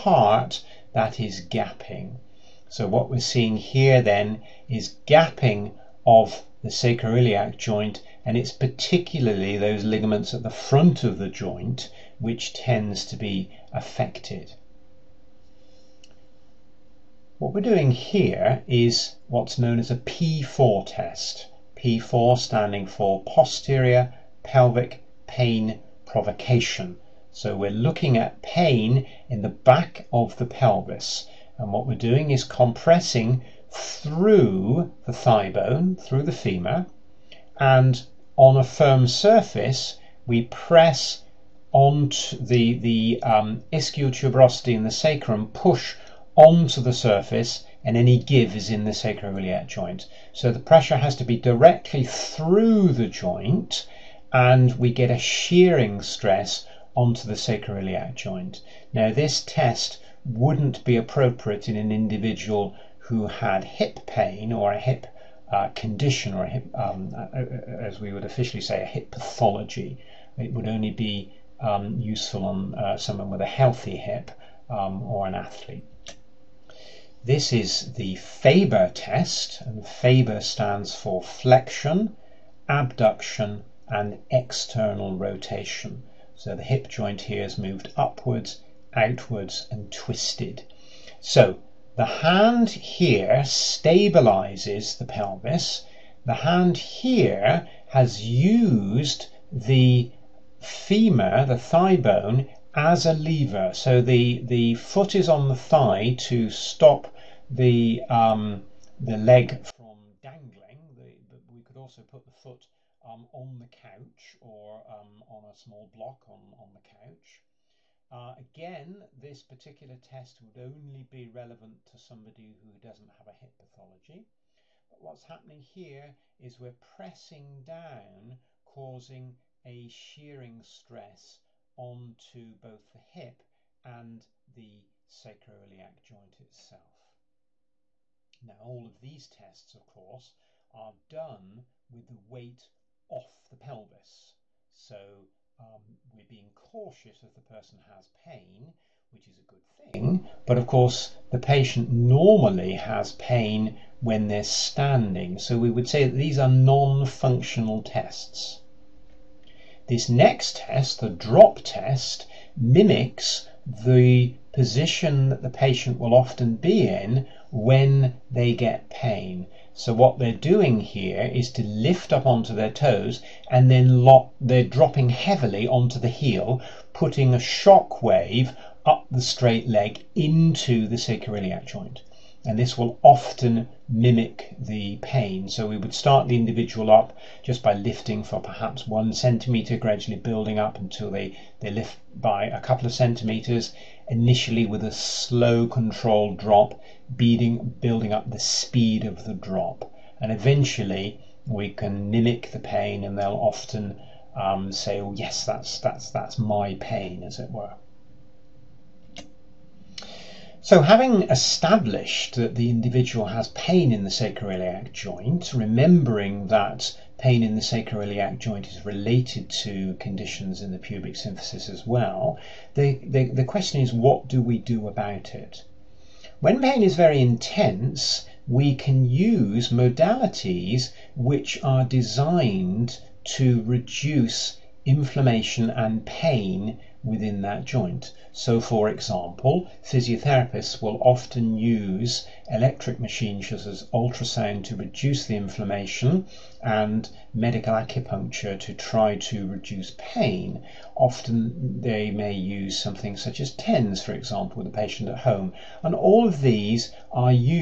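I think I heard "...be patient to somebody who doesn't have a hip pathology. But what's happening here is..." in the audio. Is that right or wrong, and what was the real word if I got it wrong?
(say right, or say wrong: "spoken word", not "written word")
wrong: "relevant", not "patient".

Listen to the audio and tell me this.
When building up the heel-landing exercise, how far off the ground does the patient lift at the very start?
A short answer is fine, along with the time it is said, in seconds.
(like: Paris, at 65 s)
1 centimeter, at 188 s.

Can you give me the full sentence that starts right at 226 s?
When pain is very intense, we can use modalities which are designed to reduce inflammation and pain within that joint.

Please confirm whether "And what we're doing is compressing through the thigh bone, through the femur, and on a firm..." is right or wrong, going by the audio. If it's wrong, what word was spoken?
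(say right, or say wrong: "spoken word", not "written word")
right.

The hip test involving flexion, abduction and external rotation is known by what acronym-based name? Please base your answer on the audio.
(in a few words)
Faber test.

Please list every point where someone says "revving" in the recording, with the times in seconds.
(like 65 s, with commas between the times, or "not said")
not said.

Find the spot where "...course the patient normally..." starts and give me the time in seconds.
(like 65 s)
150 s.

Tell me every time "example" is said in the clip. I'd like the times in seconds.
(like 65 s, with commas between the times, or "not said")
238 s, 254 s.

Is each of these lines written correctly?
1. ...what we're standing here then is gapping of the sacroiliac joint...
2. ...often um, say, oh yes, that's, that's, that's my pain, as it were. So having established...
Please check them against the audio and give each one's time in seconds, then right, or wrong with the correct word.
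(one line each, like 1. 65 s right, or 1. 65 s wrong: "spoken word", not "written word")
1. 2 s wrong: "seeing", not "standing"
2. 203 s right.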